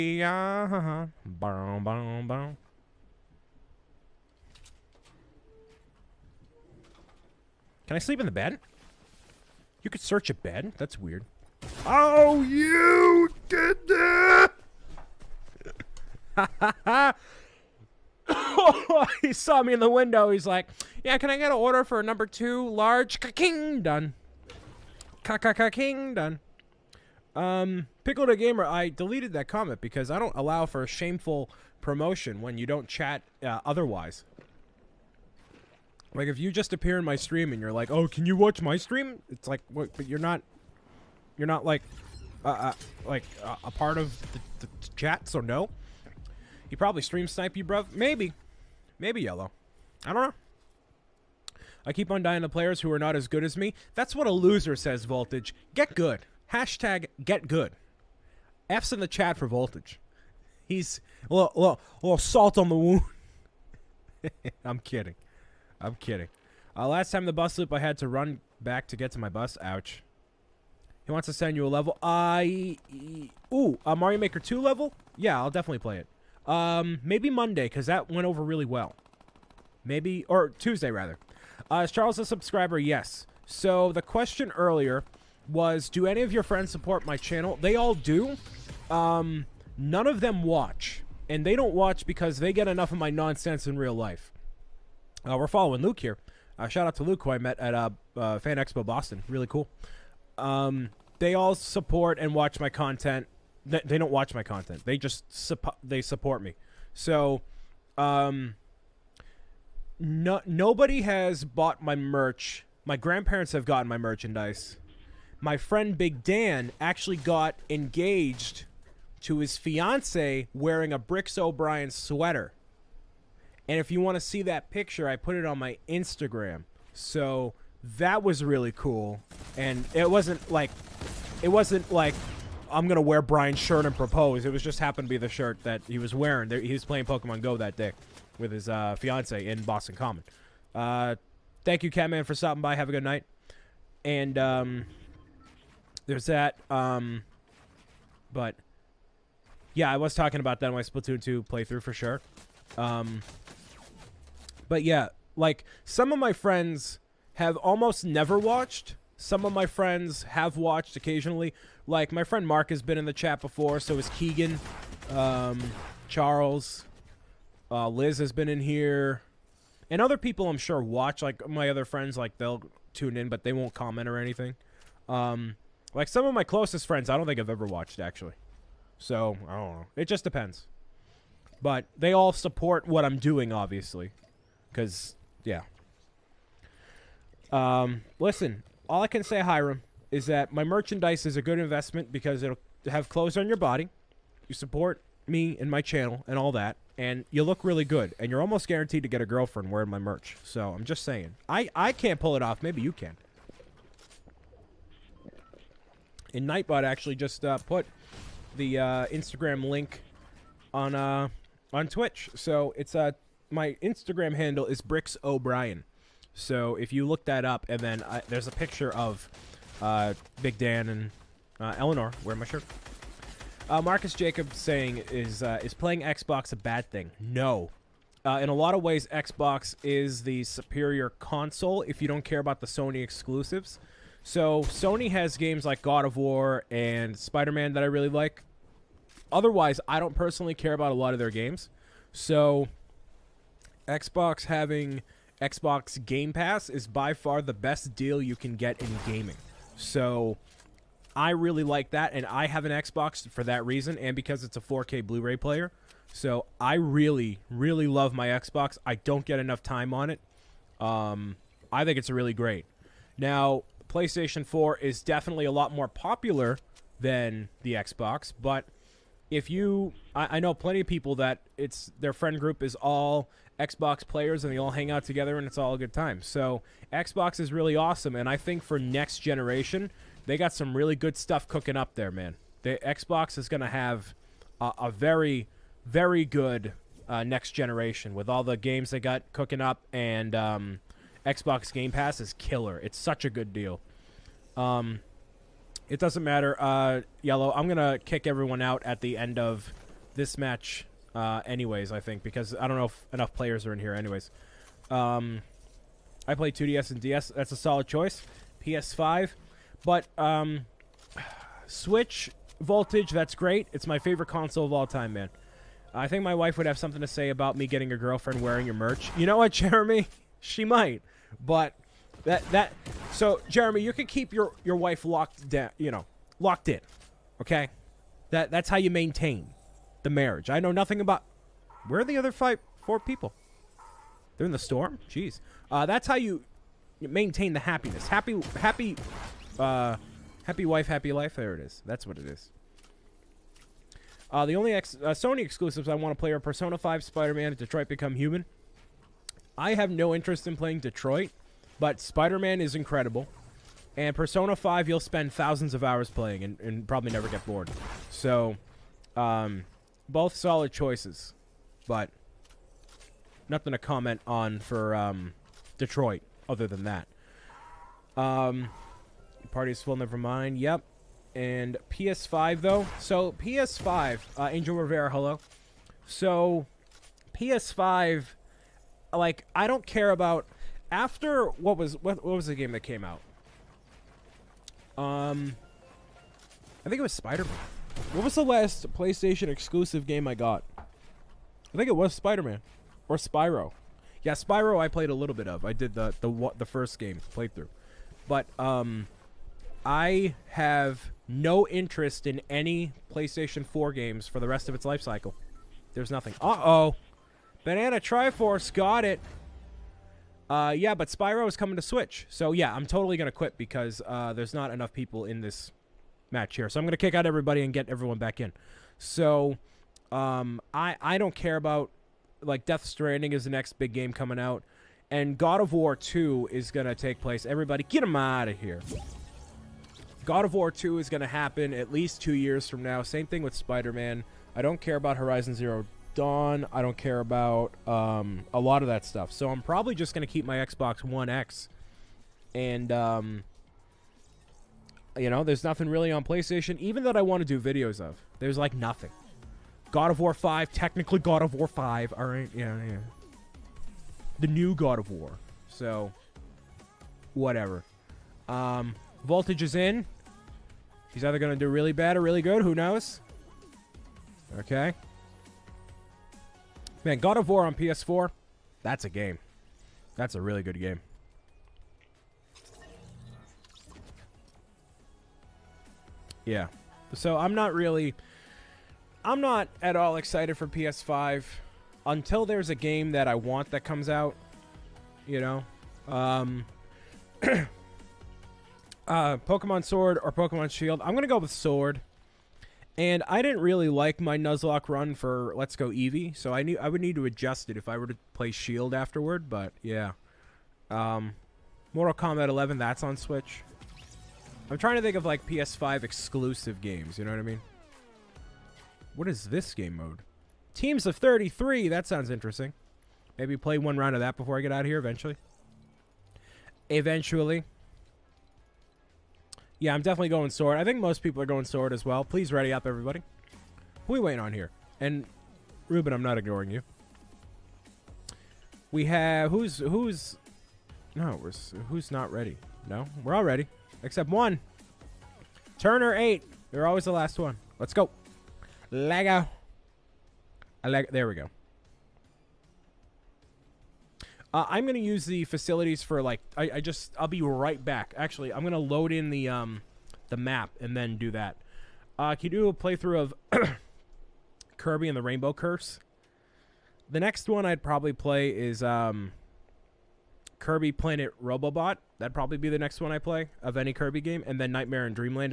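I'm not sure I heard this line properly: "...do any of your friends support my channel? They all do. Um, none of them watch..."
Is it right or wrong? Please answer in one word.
right.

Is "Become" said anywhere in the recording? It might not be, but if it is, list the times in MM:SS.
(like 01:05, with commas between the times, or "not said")
05:47.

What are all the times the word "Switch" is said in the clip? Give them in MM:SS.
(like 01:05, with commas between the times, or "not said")
05:11, 06:51, 08:23.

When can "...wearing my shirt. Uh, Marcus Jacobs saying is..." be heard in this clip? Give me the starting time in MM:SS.
03:42.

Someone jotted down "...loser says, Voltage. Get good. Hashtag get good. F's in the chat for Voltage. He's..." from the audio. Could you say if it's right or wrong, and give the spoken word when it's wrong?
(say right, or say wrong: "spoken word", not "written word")
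right.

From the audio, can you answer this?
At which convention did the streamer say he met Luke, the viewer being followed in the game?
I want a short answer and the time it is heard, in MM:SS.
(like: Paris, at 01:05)
Fan Expo Boston, at 01:38.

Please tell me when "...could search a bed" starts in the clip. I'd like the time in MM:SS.
00:09.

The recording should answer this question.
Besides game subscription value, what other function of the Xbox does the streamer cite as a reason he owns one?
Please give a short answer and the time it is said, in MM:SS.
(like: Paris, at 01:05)
4K Blu-ray player, at 04:14.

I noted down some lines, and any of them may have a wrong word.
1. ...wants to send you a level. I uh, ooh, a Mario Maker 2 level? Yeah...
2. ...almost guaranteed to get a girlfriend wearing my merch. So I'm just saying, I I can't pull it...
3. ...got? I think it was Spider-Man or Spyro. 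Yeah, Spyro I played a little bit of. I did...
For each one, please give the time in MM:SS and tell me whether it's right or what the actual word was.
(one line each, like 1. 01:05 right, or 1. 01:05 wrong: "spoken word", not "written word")
1. 01:11 right
2. 03:18 right
3. 06:30 right.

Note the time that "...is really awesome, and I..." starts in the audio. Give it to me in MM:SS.
04:37.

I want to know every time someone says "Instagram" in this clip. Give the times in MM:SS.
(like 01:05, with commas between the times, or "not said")
02:05, 03:29, 03:33.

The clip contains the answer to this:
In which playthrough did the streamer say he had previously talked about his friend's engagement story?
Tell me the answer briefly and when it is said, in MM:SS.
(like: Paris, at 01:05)
Splatoon 2, at 02:30.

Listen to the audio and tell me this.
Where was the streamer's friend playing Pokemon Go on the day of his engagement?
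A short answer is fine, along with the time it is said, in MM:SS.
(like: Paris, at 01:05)
Boston Common, at 02:19.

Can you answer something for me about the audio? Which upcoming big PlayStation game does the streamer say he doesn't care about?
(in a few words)
Death Stranding.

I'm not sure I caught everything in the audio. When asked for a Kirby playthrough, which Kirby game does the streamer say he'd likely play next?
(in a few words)
Kirby Planet Robobot.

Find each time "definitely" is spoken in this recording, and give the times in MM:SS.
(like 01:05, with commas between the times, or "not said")
01:15, 04:25, 08:40.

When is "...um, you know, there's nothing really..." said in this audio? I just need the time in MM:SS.
07:22.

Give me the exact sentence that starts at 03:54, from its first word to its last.
So Sony has games like God of War and Spider-Man that I really like.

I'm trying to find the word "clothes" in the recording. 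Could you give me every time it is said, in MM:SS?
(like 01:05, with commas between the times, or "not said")
03:13.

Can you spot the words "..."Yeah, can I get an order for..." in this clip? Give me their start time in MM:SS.
00:21.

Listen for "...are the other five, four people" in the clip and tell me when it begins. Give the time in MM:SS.
05:32.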